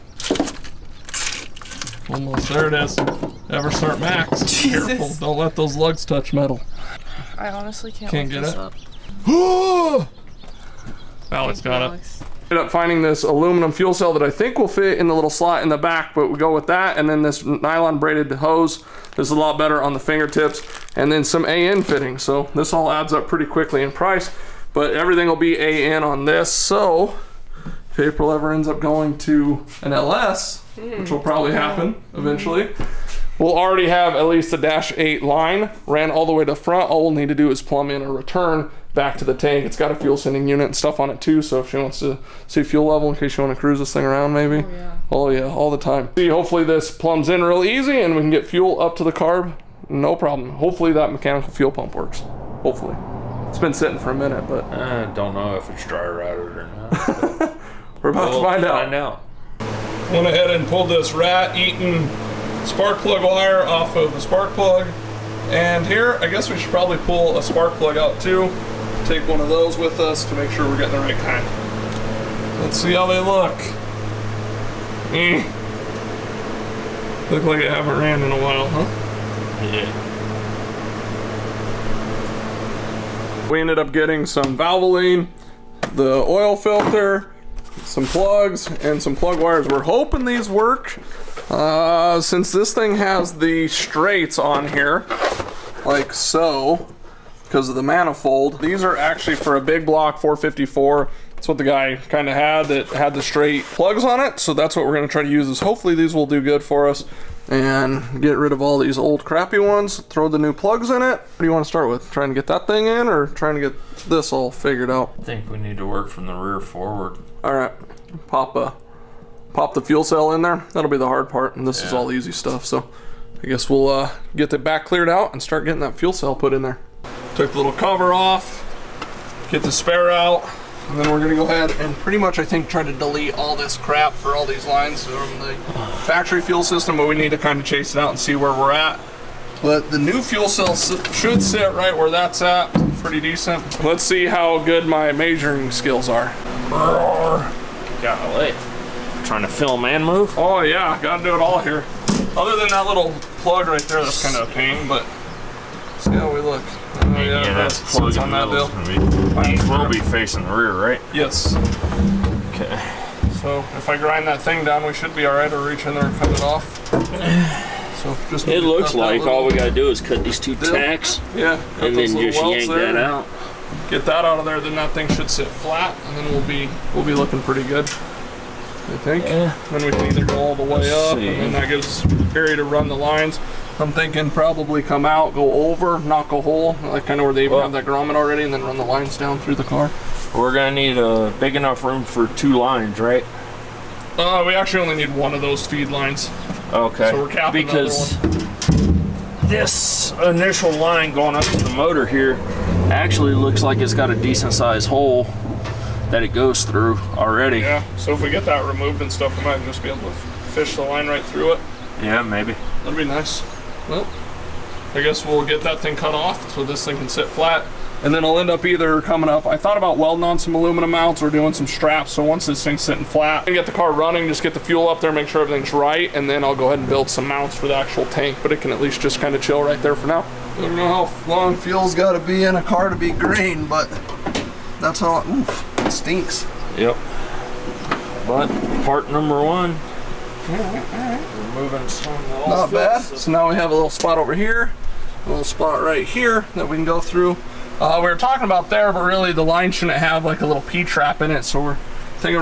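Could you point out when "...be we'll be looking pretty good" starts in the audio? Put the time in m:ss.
2:56.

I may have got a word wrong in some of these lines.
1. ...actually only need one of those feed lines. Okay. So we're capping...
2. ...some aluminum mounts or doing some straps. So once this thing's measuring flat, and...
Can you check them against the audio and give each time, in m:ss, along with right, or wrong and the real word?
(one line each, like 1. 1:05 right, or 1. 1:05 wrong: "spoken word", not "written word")
1. 3:14 right
2. 3:40 wrong: "sitting", not "measuring".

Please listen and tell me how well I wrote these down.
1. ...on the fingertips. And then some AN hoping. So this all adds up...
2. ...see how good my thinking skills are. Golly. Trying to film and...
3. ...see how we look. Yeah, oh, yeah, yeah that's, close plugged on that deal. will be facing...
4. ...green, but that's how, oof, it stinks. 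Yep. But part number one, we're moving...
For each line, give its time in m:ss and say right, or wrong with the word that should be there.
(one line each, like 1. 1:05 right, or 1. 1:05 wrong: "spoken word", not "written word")
1. 0:19 wrong: "fitting", not "hoping"
2. 2:24 wrong: "measuring", not "thinking"
3. 2:35 right
4. 3:53 right.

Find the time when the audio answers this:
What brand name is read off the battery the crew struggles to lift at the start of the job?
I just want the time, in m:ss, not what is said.
0:02.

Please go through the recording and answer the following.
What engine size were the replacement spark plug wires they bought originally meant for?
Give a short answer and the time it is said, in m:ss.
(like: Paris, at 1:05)
big block 454, at 1:39.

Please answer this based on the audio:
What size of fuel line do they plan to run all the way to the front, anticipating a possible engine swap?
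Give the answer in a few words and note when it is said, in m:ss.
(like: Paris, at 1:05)
dash 8, at 0:34.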